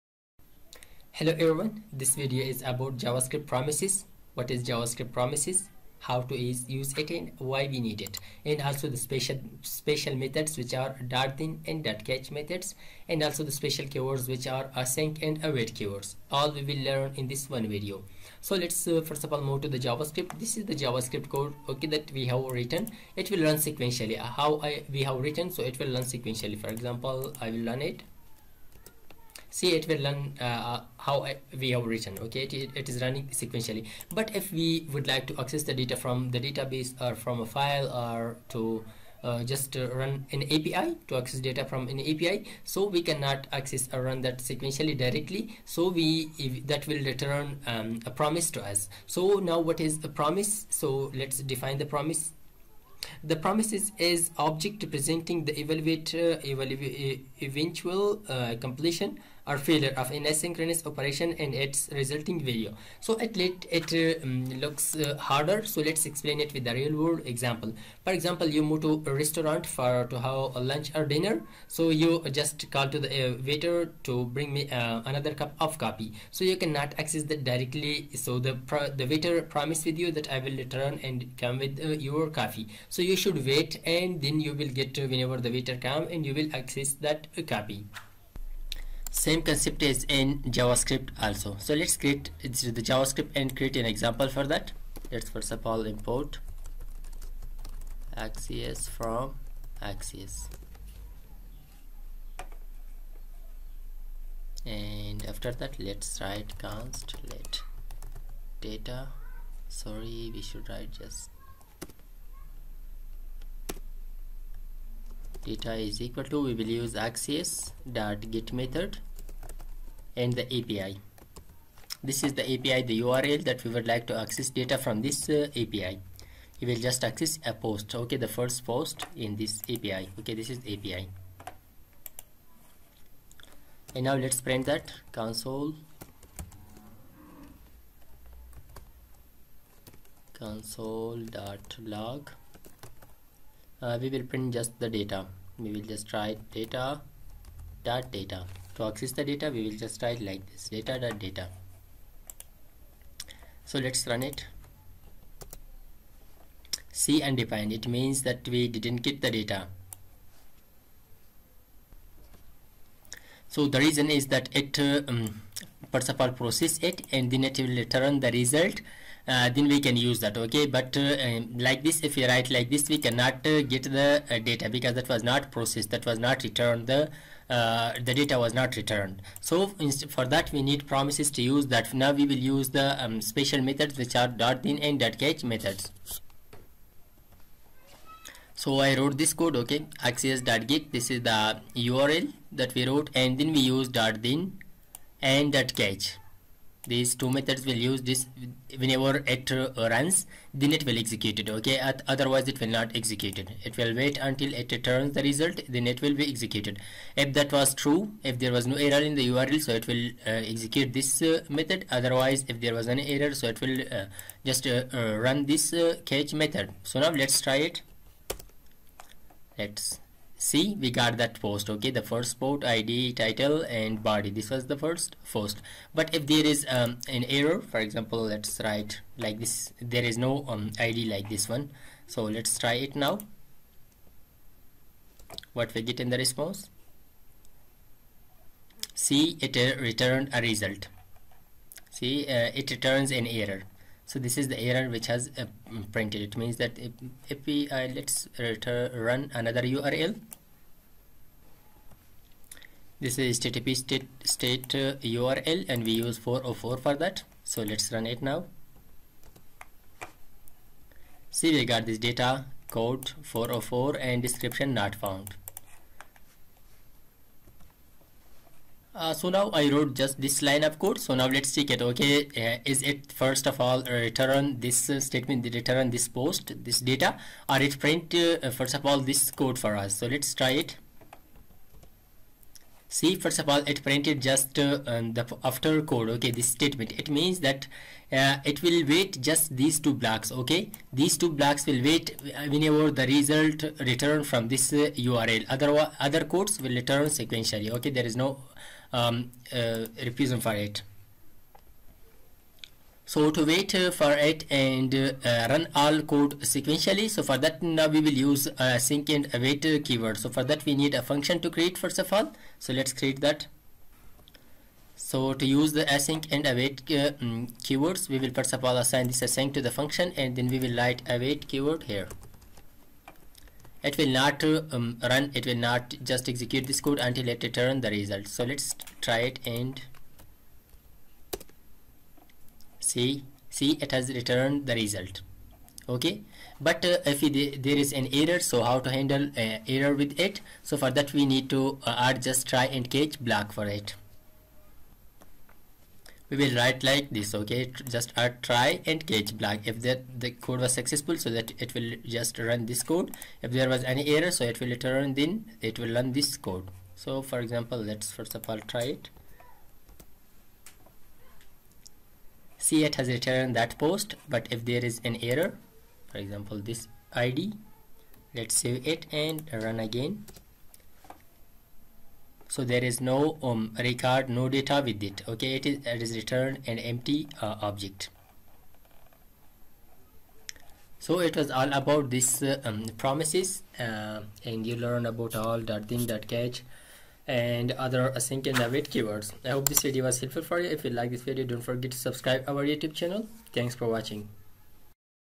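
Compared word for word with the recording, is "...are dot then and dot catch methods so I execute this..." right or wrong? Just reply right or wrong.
wrong.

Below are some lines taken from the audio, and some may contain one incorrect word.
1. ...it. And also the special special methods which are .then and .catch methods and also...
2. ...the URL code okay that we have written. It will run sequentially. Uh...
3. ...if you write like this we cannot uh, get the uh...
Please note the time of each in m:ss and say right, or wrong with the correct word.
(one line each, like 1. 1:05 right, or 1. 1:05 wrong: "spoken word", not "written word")
1. 0:08 right
2. 0:20 wrong: "JavaScript", not "URL"
3. 2:52 right.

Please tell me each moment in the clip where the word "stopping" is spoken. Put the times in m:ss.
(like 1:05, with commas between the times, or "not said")
not said.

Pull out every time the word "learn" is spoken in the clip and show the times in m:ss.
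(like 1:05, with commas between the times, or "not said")
0:16, 6:24.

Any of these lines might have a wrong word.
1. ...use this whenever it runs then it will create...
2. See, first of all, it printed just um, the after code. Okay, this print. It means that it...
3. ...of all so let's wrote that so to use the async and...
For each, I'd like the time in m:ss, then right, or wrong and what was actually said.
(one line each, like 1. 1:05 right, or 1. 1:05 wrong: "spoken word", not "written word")
1. 3:17 wrong: "execute", not "create"
2. 4:42 wrong: "statement", not "print"
3. 5:11 wrong: "create", not "wrote".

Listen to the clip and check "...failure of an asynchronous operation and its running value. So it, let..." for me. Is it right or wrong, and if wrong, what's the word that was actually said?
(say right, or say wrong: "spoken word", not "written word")
wrong: "resulting", not "running".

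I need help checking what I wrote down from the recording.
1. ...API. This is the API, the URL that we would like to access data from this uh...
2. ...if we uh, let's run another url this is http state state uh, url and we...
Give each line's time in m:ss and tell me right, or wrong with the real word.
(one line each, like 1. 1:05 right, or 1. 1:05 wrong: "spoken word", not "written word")
1. 2:00 right
2. 4:07 right.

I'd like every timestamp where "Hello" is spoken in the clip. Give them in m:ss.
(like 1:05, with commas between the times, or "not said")
0:01.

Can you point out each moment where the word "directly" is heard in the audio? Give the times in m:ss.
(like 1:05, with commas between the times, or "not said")
0:44, 1:17.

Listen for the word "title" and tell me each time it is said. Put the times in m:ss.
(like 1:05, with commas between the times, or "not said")
3:43.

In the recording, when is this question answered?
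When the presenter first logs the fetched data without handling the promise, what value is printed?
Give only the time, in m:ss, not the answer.
2:37.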